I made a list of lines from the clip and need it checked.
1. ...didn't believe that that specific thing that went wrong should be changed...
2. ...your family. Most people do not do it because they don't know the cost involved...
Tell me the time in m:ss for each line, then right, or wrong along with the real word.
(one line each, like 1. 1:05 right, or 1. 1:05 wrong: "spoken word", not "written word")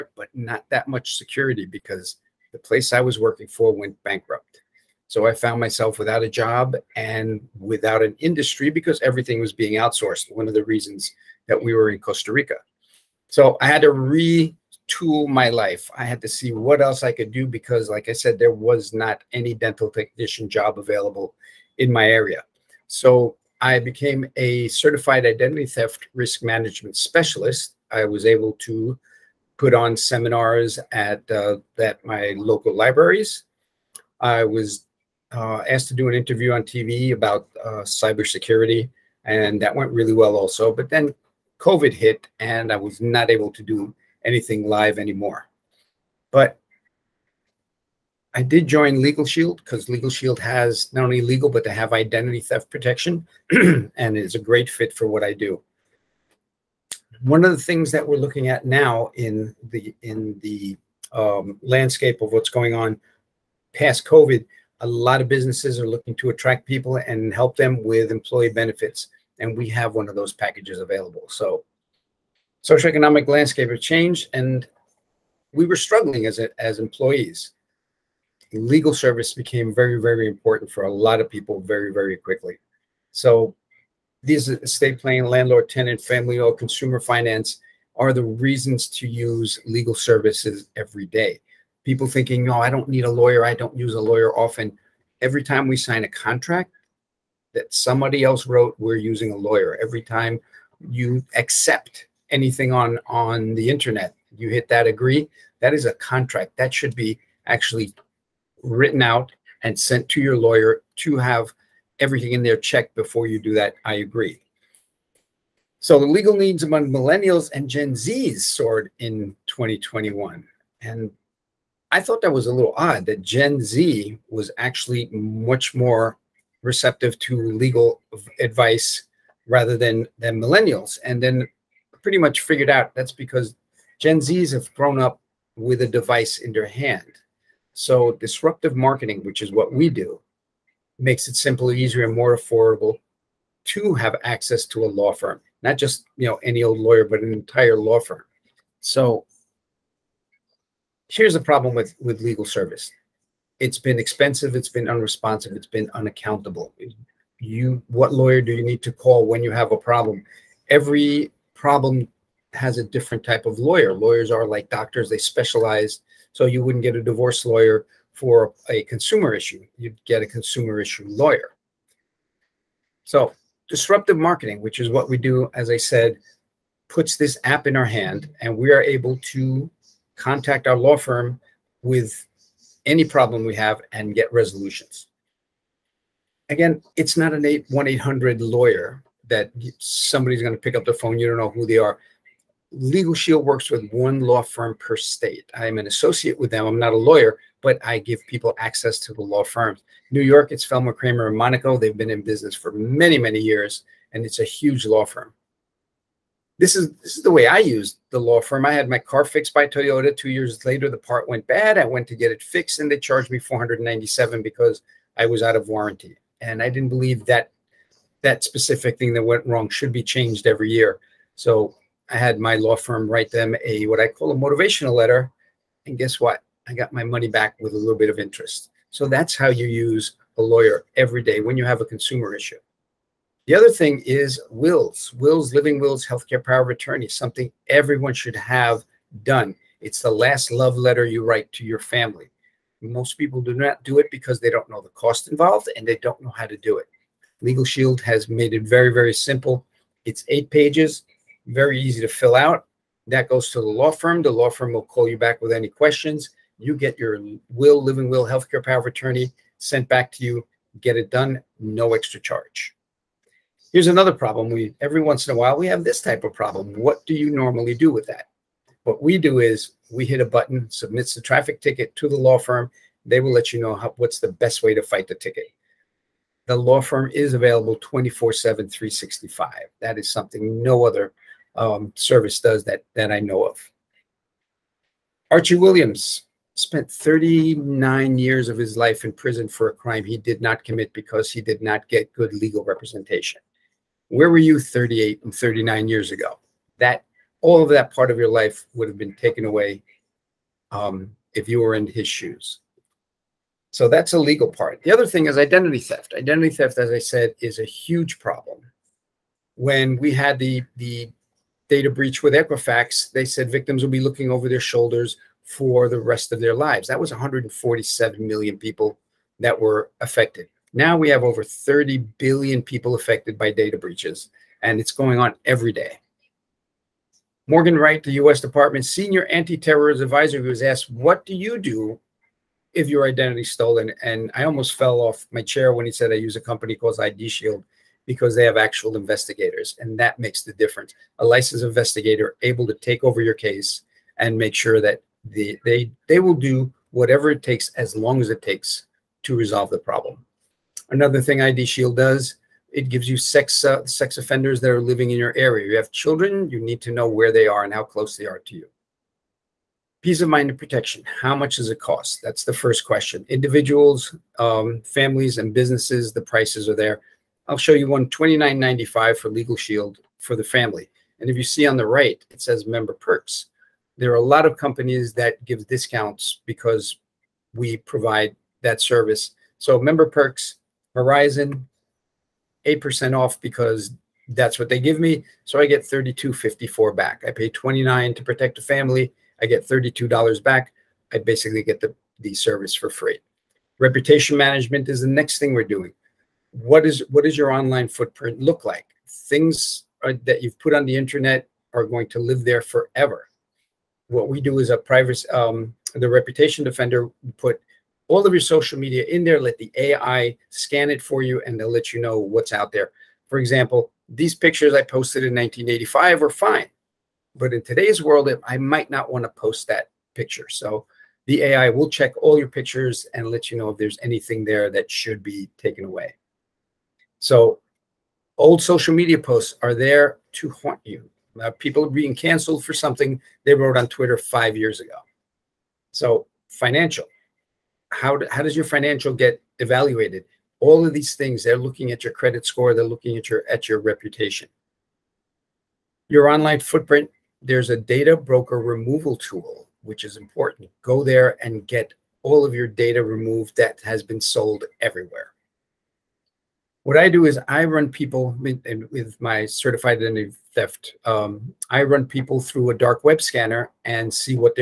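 1. 3:36 right
2. 4:01 right.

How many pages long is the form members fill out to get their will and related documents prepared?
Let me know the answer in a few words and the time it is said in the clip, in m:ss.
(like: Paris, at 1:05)
8, at 4:10.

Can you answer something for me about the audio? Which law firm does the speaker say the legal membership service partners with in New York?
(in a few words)
Feldman, Kramer, and Monaco.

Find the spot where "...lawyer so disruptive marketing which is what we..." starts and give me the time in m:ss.
2:51.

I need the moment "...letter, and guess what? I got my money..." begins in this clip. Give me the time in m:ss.
3:44.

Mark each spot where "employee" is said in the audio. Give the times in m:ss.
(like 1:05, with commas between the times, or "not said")
1:08, 1:16.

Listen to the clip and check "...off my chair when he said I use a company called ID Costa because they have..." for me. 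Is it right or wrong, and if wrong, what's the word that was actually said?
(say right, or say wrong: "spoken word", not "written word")
wrong: "Shield", not "Costa".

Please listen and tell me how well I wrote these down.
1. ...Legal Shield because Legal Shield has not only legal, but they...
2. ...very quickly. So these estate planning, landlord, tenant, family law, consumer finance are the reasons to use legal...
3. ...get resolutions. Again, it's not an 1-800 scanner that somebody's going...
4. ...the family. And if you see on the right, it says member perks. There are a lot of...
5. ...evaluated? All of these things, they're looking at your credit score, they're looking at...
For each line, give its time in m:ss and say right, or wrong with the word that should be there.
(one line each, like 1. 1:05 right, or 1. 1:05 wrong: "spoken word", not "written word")
1. 0:49 right
2. 1:21 right
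3. 3:04 wrong: "lawyer", not "scanner"
4. 6:10 right
5. 7:19 right.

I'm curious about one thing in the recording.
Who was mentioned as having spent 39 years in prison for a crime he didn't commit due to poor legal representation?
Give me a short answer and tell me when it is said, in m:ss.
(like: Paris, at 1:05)
Archie Williams, at 4:45.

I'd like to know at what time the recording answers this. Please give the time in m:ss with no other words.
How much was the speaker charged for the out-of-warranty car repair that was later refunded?
3:33.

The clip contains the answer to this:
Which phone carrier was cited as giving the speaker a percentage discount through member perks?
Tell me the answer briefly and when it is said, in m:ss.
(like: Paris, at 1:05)
Verizon, at 6:20.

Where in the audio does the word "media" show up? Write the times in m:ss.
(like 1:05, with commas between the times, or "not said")
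6:48, 7:08.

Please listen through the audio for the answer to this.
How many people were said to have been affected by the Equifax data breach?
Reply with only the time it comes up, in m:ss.
5:17.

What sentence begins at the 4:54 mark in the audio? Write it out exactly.
Where were you 38 and 39 years ago?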